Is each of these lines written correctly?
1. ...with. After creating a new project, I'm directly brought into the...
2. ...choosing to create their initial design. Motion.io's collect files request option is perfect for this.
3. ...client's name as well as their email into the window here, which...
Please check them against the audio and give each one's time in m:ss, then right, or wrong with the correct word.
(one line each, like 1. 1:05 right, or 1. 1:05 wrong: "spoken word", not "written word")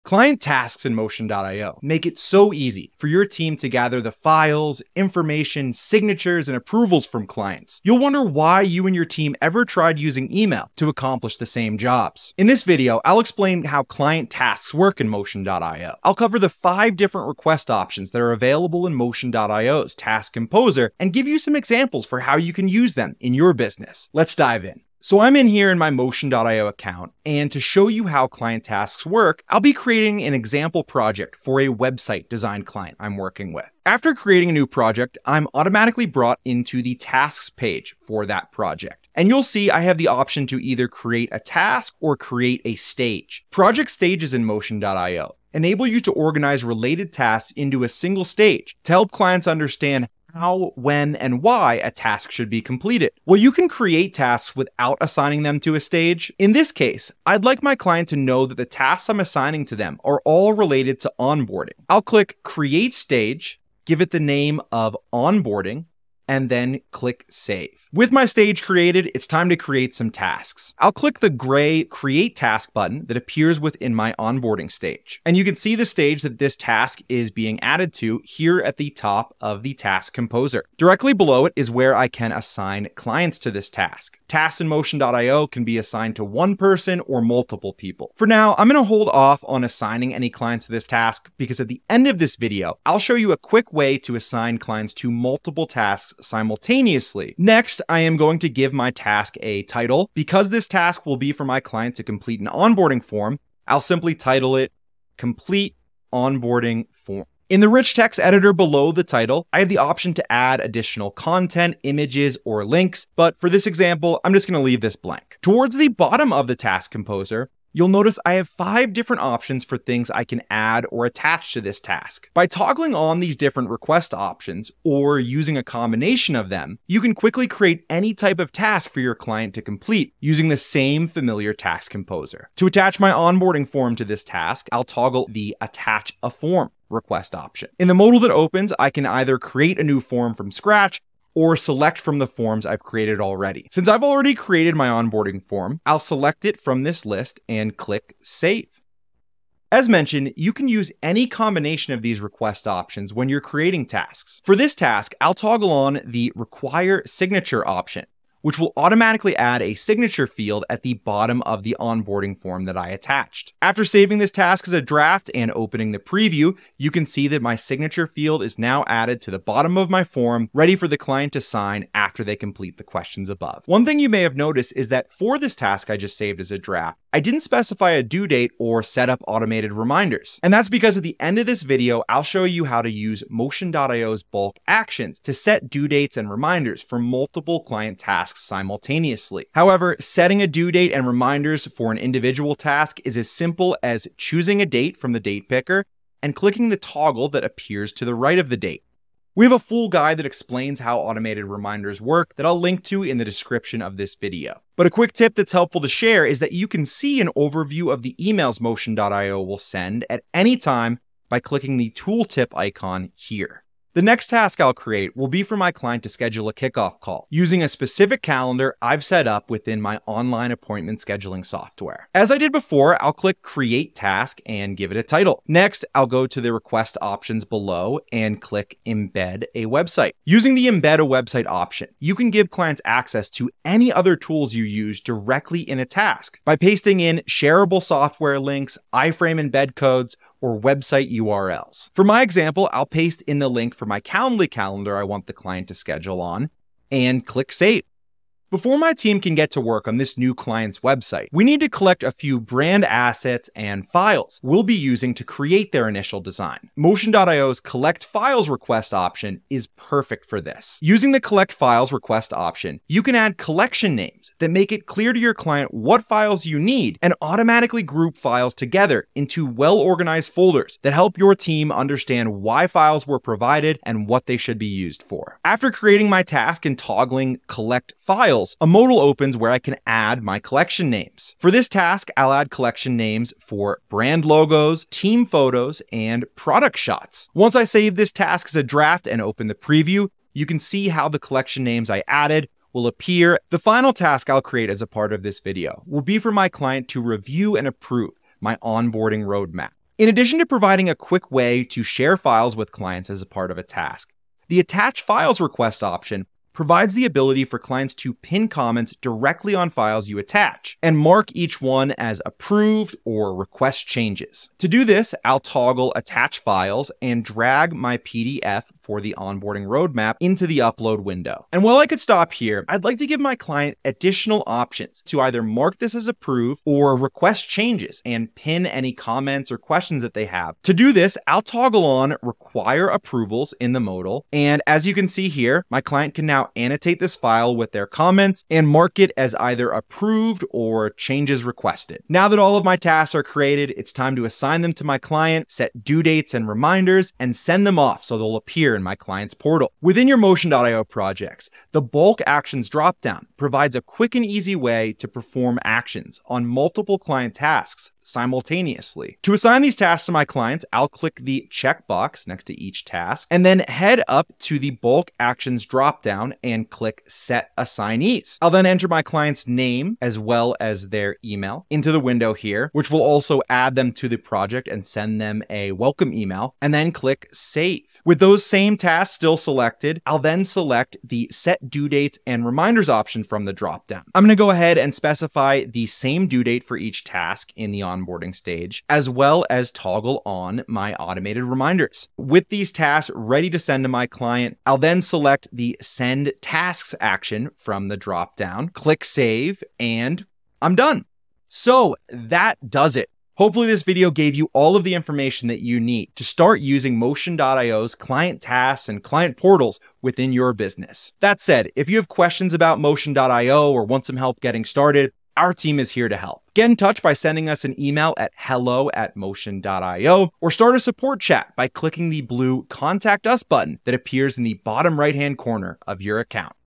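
1. 0:33 wrong: "automatically", not "directly"
2. 4:14 wrong: "using", not "choosing"
3. 6:09 right.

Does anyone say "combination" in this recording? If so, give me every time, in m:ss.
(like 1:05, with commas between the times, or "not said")
2:05, 2:31.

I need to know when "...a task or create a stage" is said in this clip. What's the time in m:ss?
0:41.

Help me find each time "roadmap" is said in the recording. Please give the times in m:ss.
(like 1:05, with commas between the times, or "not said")
4:59, 5:19.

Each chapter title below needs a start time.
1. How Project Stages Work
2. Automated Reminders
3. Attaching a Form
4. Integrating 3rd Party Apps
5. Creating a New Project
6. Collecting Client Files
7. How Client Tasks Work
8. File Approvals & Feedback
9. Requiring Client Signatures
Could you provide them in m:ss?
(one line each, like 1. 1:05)
1. 0:39
2. 2:53
3. 2:13
4. 3:30
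5. 0:24
6. 4:16
7. 1:11
8. 5:05
9. 2:30.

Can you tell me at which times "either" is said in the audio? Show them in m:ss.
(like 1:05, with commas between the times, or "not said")
0:40, 2:19, 5:25, 5:39.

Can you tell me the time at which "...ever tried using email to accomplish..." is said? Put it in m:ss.
0:09.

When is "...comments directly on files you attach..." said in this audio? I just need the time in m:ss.
5:08.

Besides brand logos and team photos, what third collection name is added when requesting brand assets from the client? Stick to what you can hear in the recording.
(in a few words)
Product shots.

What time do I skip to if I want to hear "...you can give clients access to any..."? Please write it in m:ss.
3:51.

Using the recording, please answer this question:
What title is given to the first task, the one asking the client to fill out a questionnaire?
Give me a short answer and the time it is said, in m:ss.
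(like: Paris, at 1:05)
Complete Onboarding Form, at 1:45.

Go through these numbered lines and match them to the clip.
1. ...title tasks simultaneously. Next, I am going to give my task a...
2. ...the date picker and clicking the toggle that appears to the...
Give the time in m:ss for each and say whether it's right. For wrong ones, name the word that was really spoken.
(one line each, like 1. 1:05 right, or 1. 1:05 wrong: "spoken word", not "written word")
1. 1:35 wrong: "multiple", not "title"
2. 3:15 right.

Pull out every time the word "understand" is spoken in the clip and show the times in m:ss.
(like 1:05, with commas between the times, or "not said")
0:49, 4:31.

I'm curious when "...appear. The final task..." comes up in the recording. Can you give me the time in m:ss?
4:52.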